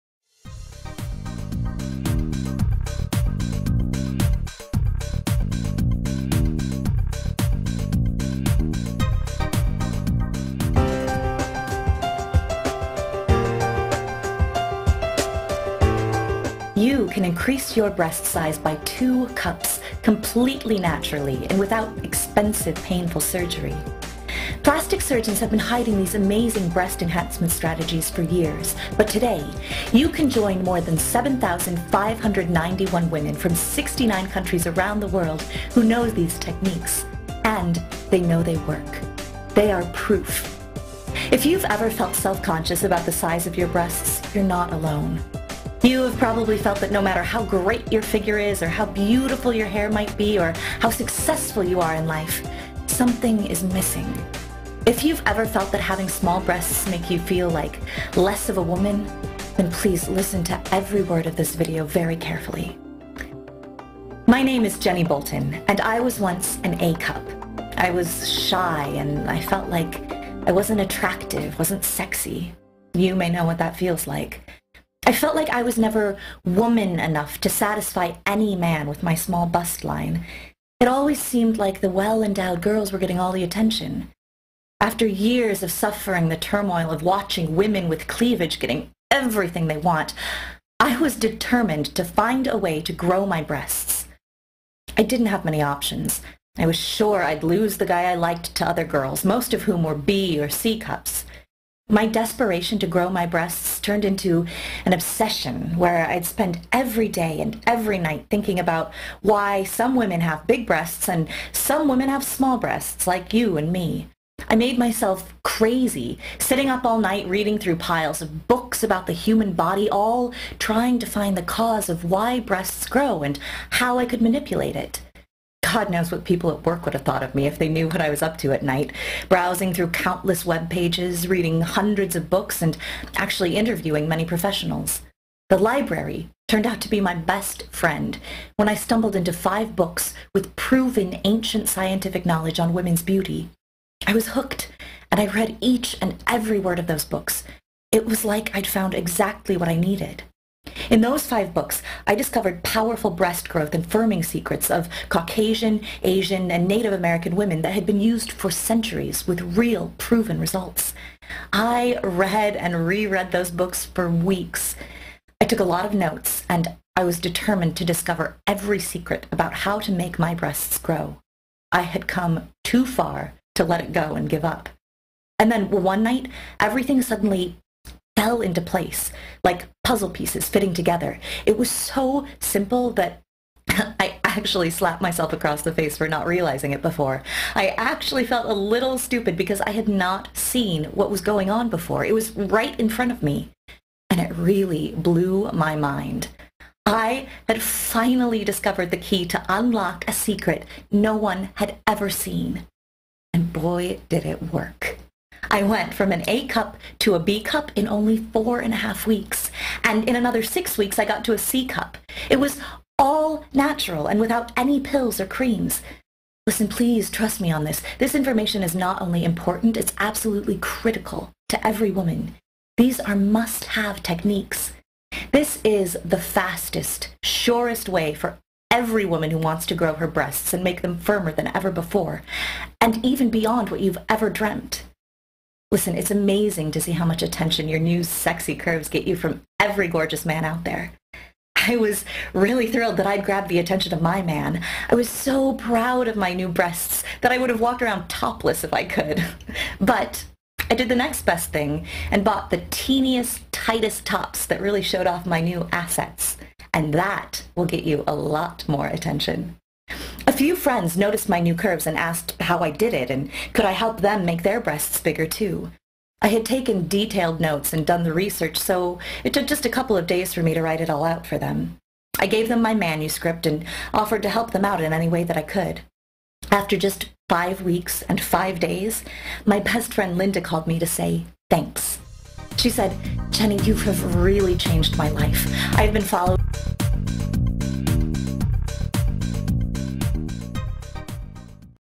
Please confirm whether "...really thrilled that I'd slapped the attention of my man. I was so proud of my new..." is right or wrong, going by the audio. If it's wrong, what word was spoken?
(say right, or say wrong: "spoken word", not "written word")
wrong: "grabbed", not "slapped".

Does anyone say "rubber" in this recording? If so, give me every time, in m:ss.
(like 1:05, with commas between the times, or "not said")
not said.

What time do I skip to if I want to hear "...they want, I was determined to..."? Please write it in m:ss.
1:29.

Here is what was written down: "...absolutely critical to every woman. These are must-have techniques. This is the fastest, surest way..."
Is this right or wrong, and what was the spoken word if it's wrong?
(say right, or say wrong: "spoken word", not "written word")
right.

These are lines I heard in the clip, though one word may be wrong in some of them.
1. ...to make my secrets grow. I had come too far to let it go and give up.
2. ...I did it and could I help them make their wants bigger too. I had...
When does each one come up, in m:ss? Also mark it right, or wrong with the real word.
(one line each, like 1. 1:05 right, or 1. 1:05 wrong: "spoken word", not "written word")
1. 2:49 wrong: "breasts", not "secrets"
2. 4:22 wrong: "breasts", not "wants".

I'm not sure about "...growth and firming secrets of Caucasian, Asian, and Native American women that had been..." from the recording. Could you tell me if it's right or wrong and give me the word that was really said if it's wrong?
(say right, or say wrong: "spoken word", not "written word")
right.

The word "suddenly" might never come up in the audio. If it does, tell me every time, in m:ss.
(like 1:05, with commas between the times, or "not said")
2:57.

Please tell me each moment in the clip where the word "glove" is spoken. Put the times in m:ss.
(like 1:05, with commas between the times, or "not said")
not said.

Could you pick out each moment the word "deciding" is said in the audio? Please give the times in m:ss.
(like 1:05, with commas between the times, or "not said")
not said.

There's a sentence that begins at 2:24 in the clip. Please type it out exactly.
I was hooked, and I read each and every word of those books.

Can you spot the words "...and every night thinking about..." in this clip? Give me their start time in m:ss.
1:47.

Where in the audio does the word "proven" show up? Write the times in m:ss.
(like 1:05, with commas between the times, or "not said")
2:20, 2:39.